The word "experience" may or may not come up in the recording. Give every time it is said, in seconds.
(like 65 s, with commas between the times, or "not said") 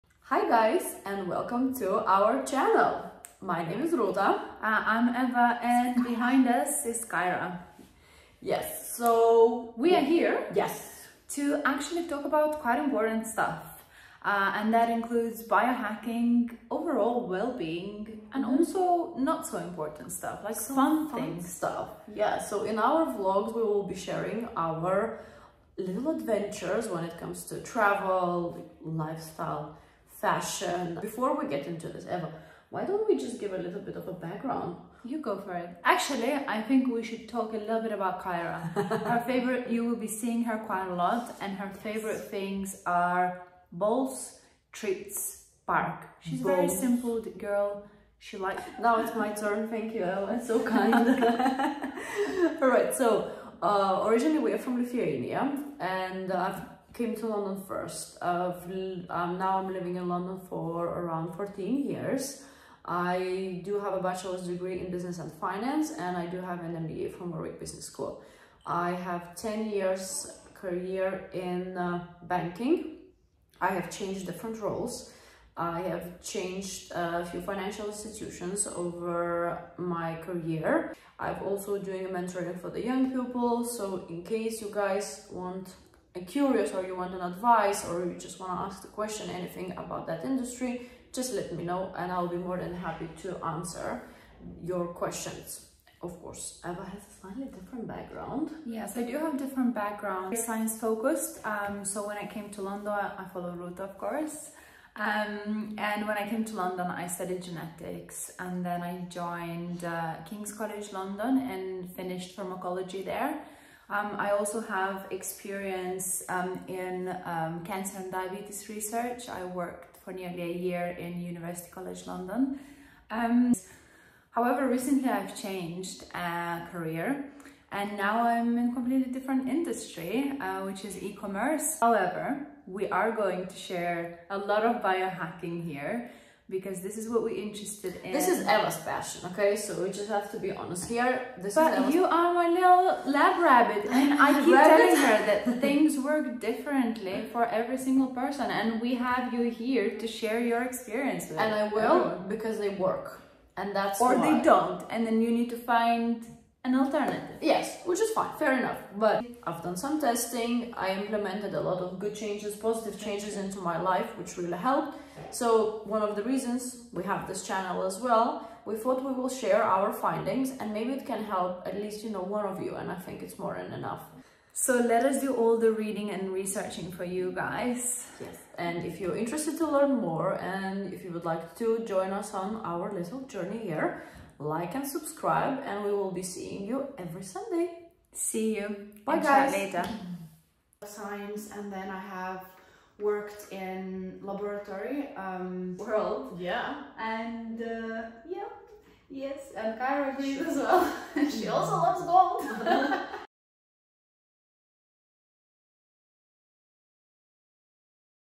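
115 s, 150 s.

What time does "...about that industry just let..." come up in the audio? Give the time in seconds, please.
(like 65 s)
89 s.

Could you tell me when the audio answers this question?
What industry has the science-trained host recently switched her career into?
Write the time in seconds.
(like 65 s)
131 s.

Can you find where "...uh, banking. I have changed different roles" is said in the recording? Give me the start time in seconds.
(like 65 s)
71 s.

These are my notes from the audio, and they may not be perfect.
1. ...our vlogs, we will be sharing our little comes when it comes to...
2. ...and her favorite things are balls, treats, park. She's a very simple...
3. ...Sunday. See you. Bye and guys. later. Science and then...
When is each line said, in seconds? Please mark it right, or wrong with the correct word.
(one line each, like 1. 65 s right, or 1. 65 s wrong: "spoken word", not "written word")
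1. 22 s wrong: "adventures", not "comes"
2. 41 s right
3. 187 s right.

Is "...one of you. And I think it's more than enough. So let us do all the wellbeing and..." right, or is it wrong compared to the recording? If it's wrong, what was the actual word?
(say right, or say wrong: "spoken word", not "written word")
wrong: "reading", not "wellbeing".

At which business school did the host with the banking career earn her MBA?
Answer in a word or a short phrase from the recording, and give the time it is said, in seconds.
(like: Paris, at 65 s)
Warwick Business School, at 67 s.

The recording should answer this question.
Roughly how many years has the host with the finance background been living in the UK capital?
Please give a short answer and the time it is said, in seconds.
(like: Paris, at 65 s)
14, at 61 s.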